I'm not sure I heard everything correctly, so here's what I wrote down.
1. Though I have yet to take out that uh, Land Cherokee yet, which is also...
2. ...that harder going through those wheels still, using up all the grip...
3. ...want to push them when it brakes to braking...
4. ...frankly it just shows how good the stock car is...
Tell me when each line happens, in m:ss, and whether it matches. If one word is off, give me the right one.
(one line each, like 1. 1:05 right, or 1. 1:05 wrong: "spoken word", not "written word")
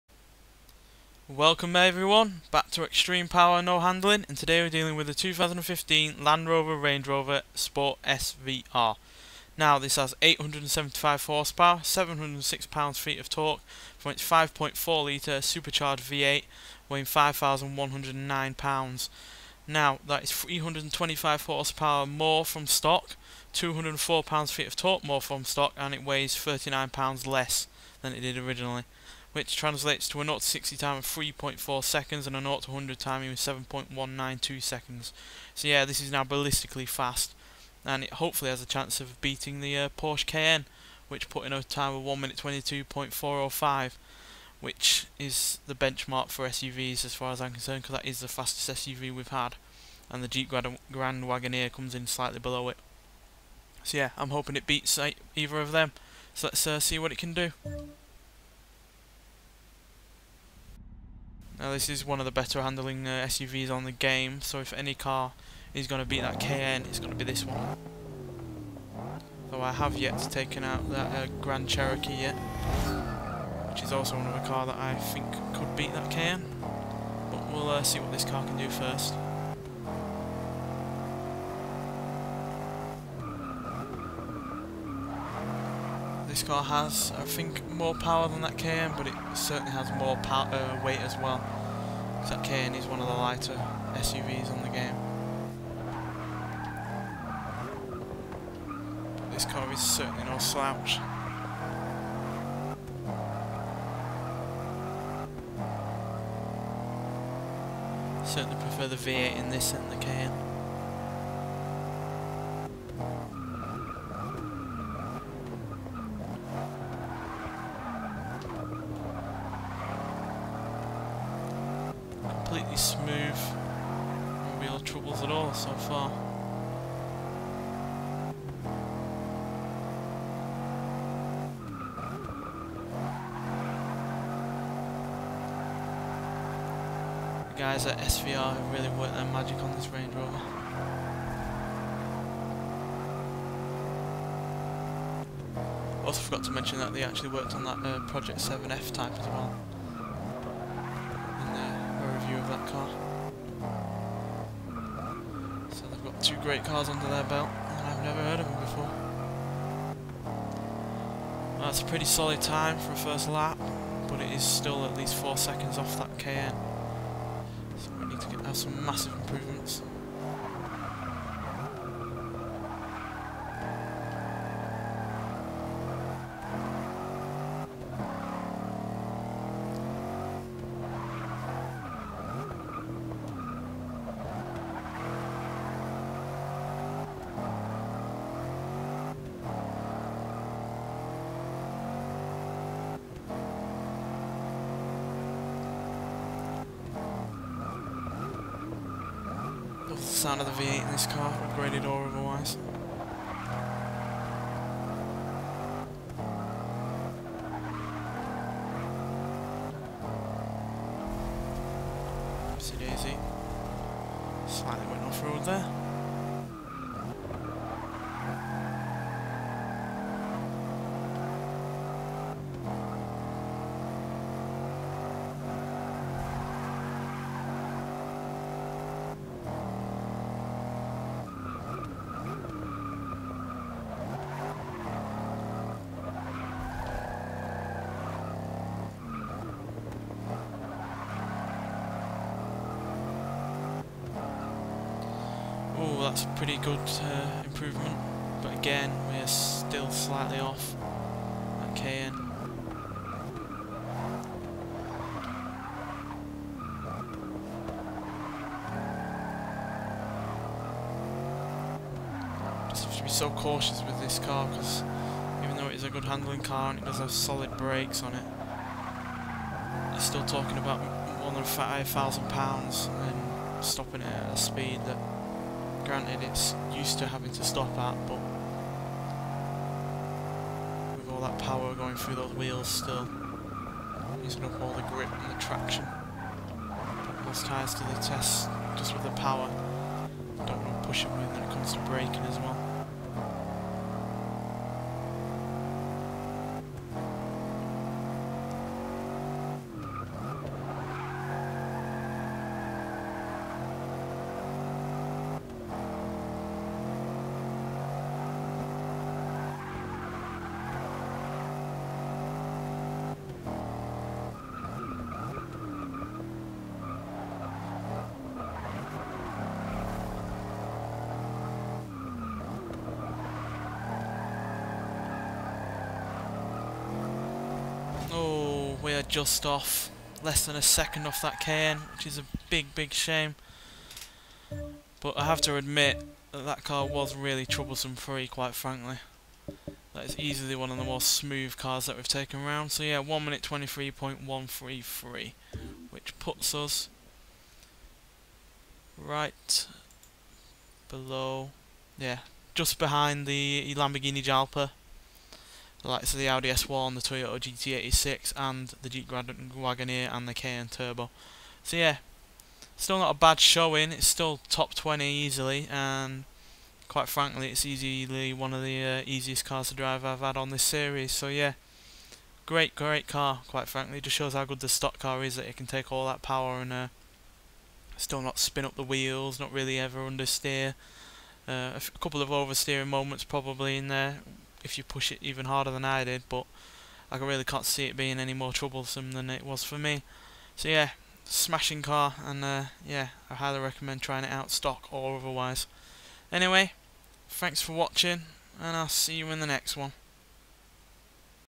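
1. 1:09 wrong: "Grand", not "Land"
2. 4:41 wrong: "power", not "harder"
3. 4:50 wrong: "comes", not "brakes"
4. 6:13 right.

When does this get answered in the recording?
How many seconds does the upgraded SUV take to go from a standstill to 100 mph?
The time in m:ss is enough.
0:33.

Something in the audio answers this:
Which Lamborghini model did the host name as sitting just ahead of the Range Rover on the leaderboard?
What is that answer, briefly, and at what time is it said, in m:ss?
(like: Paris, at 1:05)
Jalpa, at 5:53.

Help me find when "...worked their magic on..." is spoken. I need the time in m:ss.
2:18.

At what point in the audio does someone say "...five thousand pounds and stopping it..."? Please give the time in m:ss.
4:31.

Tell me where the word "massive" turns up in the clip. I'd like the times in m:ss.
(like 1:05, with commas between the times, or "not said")
2:48.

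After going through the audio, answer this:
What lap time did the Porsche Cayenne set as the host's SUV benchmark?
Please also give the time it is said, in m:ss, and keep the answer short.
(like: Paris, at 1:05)
1 minute 22.405, at 0:42.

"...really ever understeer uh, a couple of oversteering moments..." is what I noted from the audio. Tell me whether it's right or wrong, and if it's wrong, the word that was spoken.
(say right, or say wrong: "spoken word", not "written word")
right.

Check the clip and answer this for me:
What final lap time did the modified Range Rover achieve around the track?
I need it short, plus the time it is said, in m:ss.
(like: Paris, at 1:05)
1 minute 23.133, at 5:42.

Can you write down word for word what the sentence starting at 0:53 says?
So yeah, I'm hoping it beats uh, either of them.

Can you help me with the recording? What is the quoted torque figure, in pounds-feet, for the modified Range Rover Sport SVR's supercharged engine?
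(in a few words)
706.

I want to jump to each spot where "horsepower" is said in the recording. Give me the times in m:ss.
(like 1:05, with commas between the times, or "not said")
0:11, 0:21.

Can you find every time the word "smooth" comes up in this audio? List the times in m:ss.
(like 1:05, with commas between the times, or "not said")
2:02, 5:41.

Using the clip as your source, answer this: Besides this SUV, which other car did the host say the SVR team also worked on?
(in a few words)
Project 7 F-Type.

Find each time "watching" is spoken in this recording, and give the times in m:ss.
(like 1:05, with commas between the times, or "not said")
6:37.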